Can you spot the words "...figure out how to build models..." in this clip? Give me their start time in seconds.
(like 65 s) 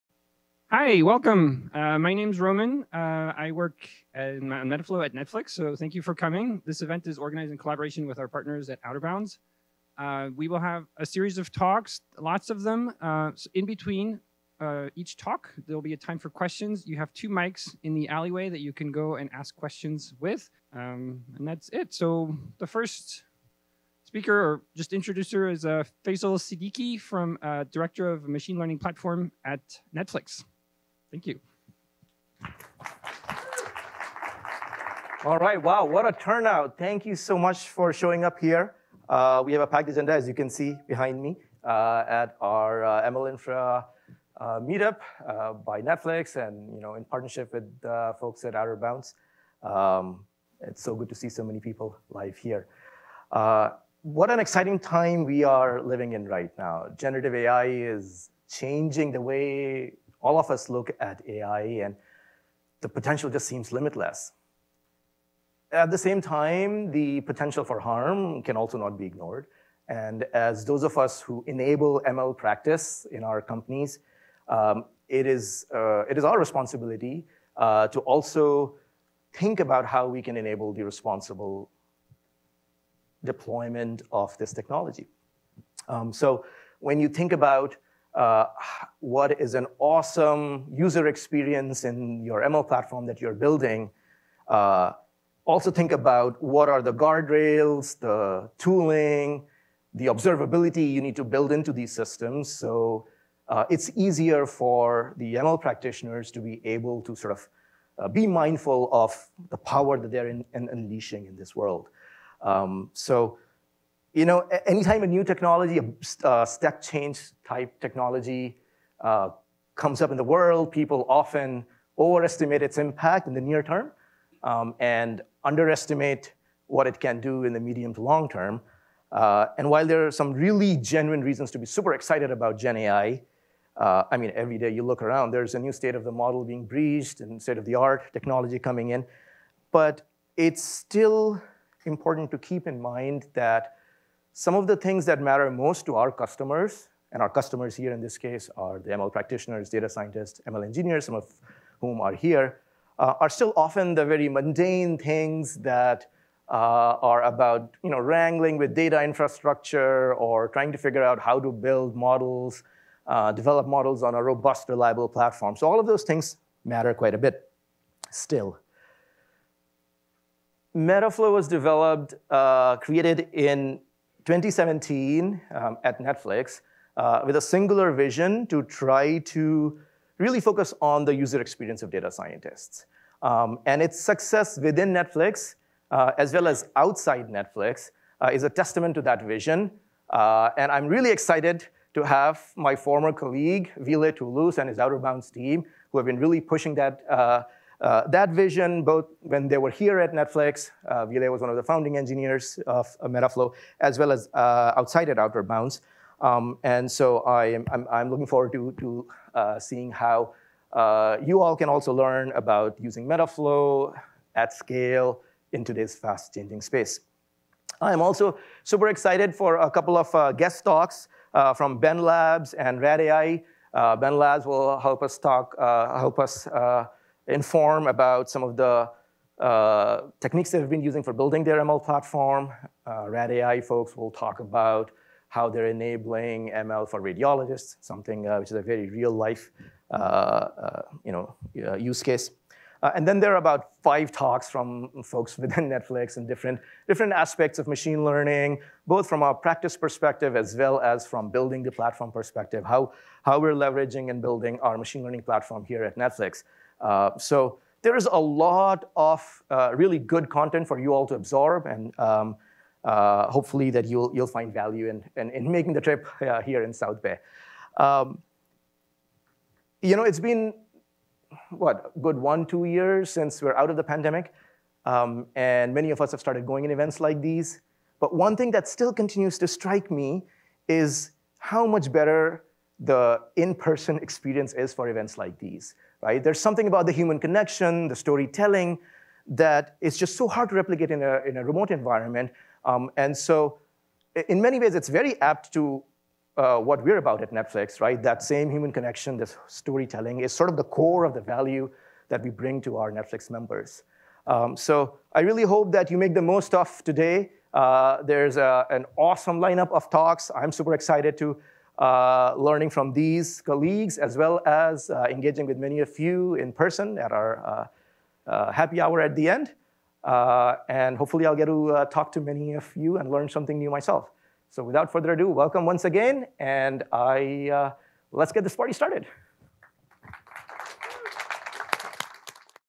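160 s.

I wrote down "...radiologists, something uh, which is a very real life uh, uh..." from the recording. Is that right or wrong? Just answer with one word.
right.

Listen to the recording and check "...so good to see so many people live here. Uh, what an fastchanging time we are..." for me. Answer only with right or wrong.
wrong.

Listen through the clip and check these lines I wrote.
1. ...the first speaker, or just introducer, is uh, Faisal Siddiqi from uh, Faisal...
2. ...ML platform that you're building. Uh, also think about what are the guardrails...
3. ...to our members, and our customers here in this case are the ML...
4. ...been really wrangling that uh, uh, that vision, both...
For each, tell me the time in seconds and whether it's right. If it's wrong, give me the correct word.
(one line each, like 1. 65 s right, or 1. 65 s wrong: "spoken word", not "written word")
1. 22 s wrong: "Director", not "Faisal"
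2. 92 s right
3. 145 s wrong: "customers", not "members"
4. 196 s wrong: "pushing", not "wrangling".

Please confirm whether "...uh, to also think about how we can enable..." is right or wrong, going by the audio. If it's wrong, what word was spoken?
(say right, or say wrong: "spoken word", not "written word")
right.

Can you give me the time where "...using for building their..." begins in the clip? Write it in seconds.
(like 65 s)
230 s.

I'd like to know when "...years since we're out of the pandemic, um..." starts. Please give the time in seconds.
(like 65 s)
272 s.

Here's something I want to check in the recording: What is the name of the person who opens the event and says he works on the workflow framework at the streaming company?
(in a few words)
Roman.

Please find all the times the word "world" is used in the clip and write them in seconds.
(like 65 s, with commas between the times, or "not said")
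111 s, 120 s.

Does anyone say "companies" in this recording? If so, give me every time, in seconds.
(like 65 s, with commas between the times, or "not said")
73 s.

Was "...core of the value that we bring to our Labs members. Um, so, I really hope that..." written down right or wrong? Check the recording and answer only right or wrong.
wrong.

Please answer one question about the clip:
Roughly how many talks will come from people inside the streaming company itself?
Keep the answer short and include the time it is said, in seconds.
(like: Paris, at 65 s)
5, at 243 s.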